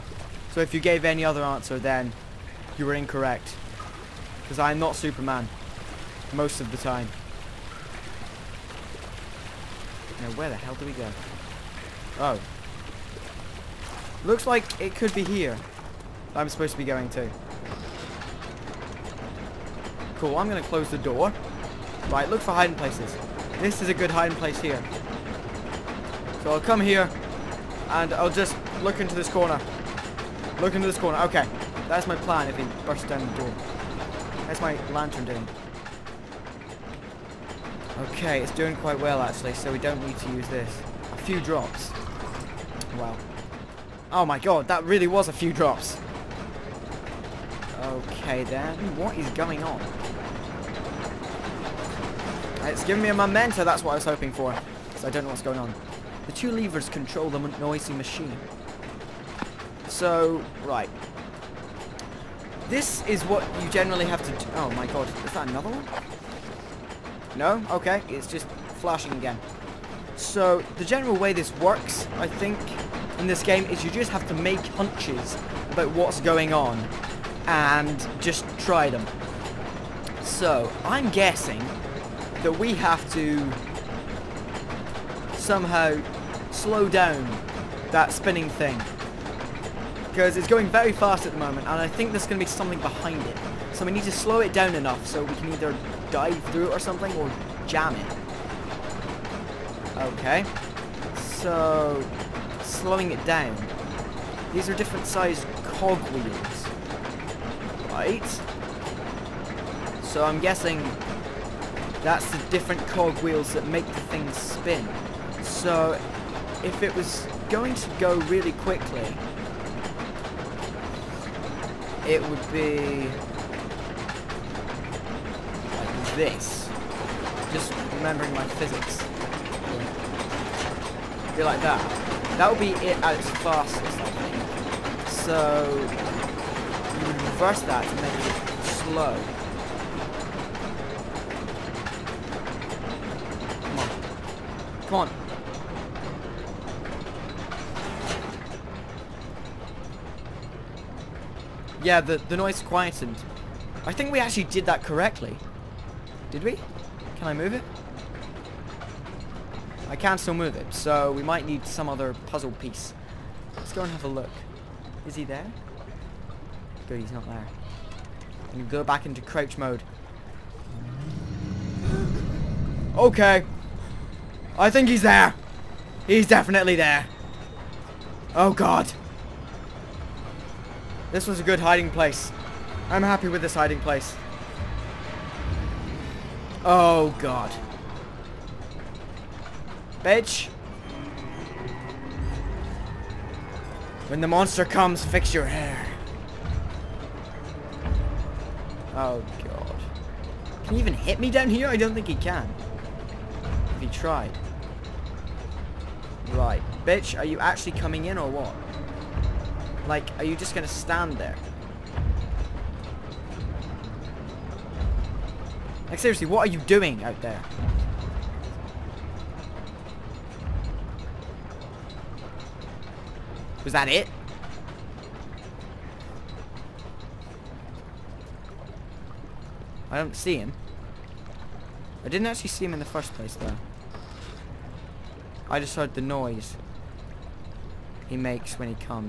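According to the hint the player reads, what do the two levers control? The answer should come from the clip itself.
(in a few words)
The noisy machine.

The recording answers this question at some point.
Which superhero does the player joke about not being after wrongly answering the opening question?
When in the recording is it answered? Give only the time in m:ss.
0:04.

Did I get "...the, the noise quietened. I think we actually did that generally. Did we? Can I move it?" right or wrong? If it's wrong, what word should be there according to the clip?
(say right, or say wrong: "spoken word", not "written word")
wrong: "correctly", not "generally".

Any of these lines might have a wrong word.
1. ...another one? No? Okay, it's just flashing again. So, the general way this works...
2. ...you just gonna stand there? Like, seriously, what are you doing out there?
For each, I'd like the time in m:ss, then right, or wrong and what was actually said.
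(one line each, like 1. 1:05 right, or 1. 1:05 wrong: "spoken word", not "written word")
1. 1:05 right
2. 3:30 right.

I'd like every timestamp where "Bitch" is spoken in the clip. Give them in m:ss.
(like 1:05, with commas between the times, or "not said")
3:10, 3:26.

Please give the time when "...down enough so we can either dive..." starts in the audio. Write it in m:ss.
1:34.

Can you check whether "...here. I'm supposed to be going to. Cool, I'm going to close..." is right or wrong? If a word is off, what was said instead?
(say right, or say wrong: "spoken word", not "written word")
right.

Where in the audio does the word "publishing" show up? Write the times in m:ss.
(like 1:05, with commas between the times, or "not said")
not said.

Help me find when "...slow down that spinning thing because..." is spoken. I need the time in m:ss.
1:26.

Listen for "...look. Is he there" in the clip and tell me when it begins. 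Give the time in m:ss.
2:44.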